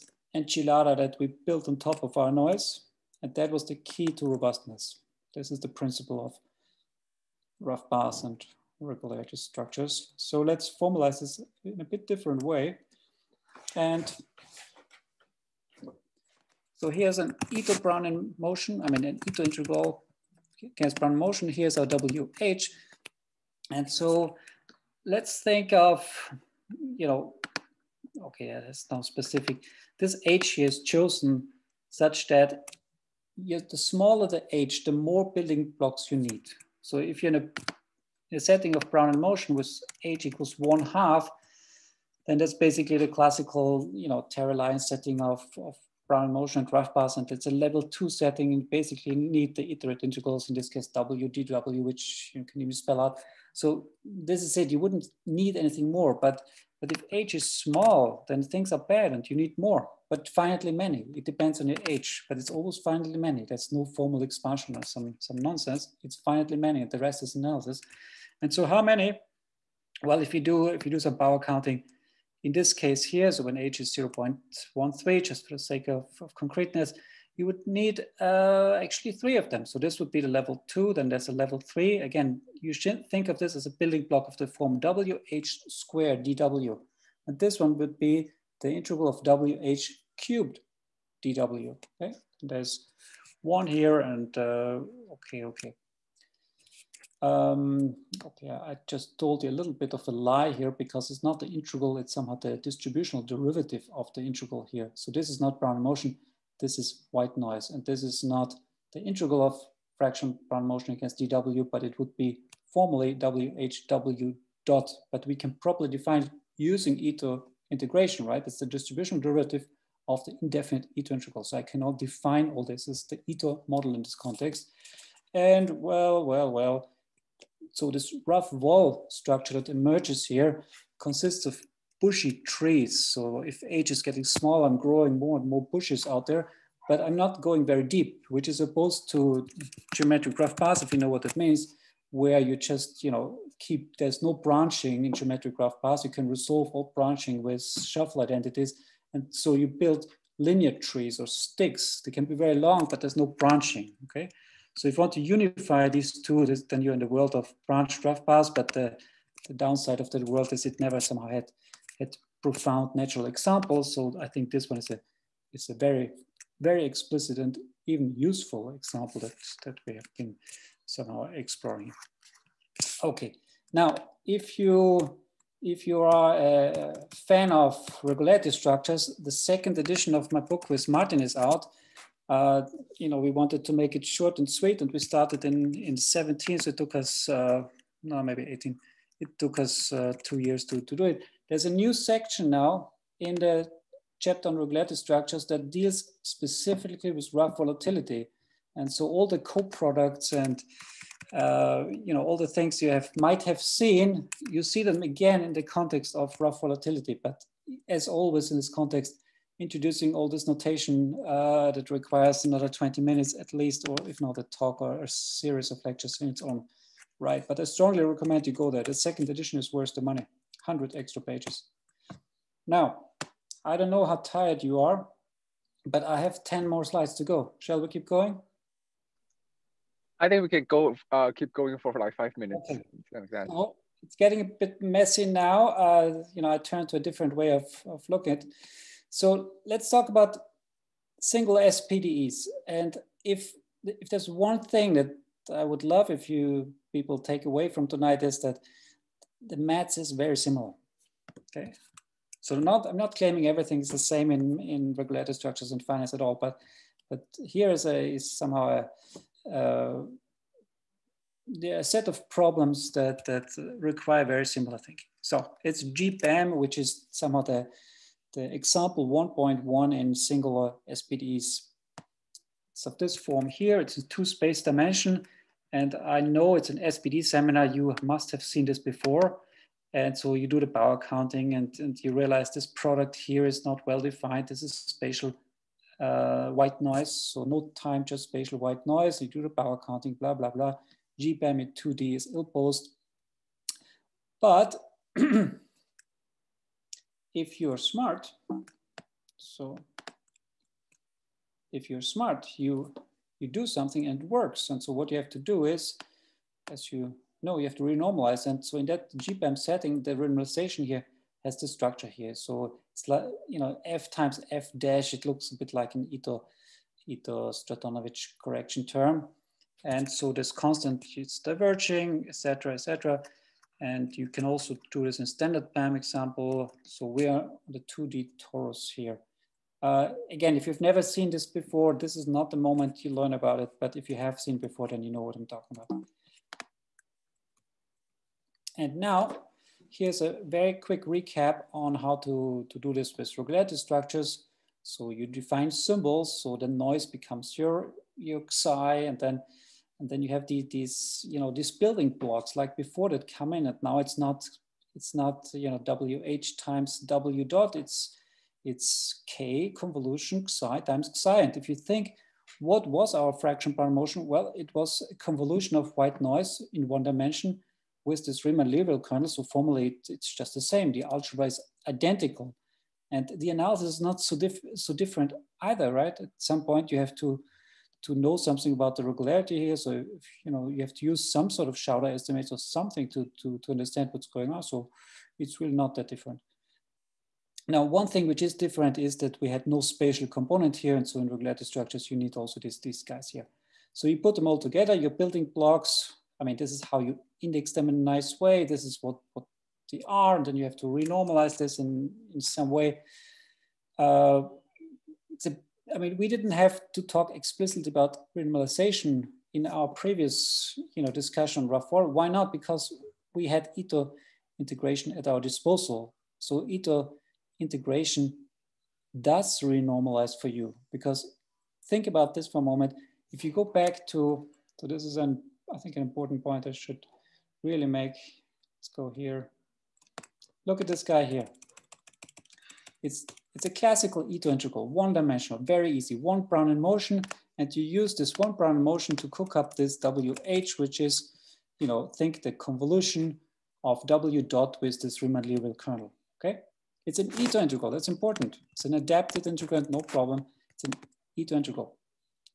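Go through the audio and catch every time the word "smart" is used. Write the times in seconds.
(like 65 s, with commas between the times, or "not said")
297 s, 302 s.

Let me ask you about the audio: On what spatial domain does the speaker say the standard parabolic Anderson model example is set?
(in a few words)
2D torus.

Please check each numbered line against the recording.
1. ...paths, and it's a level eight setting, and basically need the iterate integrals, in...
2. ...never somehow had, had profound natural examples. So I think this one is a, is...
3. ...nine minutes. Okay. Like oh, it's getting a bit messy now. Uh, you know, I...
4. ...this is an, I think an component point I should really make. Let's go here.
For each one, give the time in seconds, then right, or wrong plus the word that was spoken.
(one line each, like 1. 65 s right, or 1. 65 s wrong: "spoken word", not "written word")
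1. 46 s wrong: "two", not "eight"
2. 160 s right
3. 232 s wrong: "five", not "nine"
4. 424 s wrong: "important", not "component".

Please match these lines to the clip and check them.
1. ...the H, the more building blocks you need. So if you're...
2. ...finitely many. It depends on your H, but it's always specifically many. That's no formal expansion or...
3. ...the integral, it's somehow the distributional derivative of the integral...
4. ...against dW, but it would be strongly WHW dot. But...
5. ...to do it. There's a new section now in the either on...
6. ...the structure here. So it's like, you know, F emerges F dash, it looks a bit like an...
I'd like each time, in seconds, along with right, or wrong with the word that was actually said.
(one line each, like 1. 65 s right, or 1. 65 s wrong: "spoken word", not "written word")
1. 34 s right
2. 60 s wrong: "finitely", not "specifically"
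3. 101 s right
4. 110 s wrong: "formally", not "strongly"
5. 190 s wrong: "chapter", not "either"
6. 311 s wrong: "times", not "emerges".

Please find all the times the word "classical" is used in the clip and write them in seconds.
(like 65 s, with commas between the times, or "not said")
43 s, 433 s.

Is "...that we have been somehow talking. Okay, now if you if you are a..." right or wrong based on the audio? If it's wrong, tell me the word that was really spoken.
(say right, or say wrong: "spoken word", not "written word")
wrong: "exploring", not "talking".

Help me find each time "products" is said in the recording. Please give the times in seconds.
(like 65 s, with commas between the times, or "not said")
199 s, 282 s.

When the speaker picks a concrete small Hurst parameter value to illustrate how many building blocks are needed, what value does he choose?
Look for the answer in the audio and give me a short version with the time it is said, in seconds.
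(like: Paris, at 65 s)
0.13, at 73 s.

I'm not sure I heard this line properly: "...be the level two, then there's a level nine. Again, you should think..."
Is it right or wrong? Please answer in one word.
wrong.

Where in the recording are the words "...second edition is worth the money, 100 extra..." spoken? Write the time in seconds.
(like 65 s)
218 s.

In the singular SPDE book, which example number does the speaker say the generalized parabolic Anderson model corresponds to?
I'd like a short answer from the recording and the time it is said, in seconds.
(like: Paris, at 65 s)
1.1, at 269 s.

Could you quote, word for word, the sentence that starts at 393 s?
So you put them all together, you're building blocks.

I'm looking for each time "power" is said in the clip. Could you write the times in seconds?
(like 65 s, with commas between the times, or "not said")
71 s, 280 s, 289 s.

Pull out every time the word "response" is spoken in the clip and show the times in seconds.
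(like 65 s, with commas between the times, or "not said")
not said.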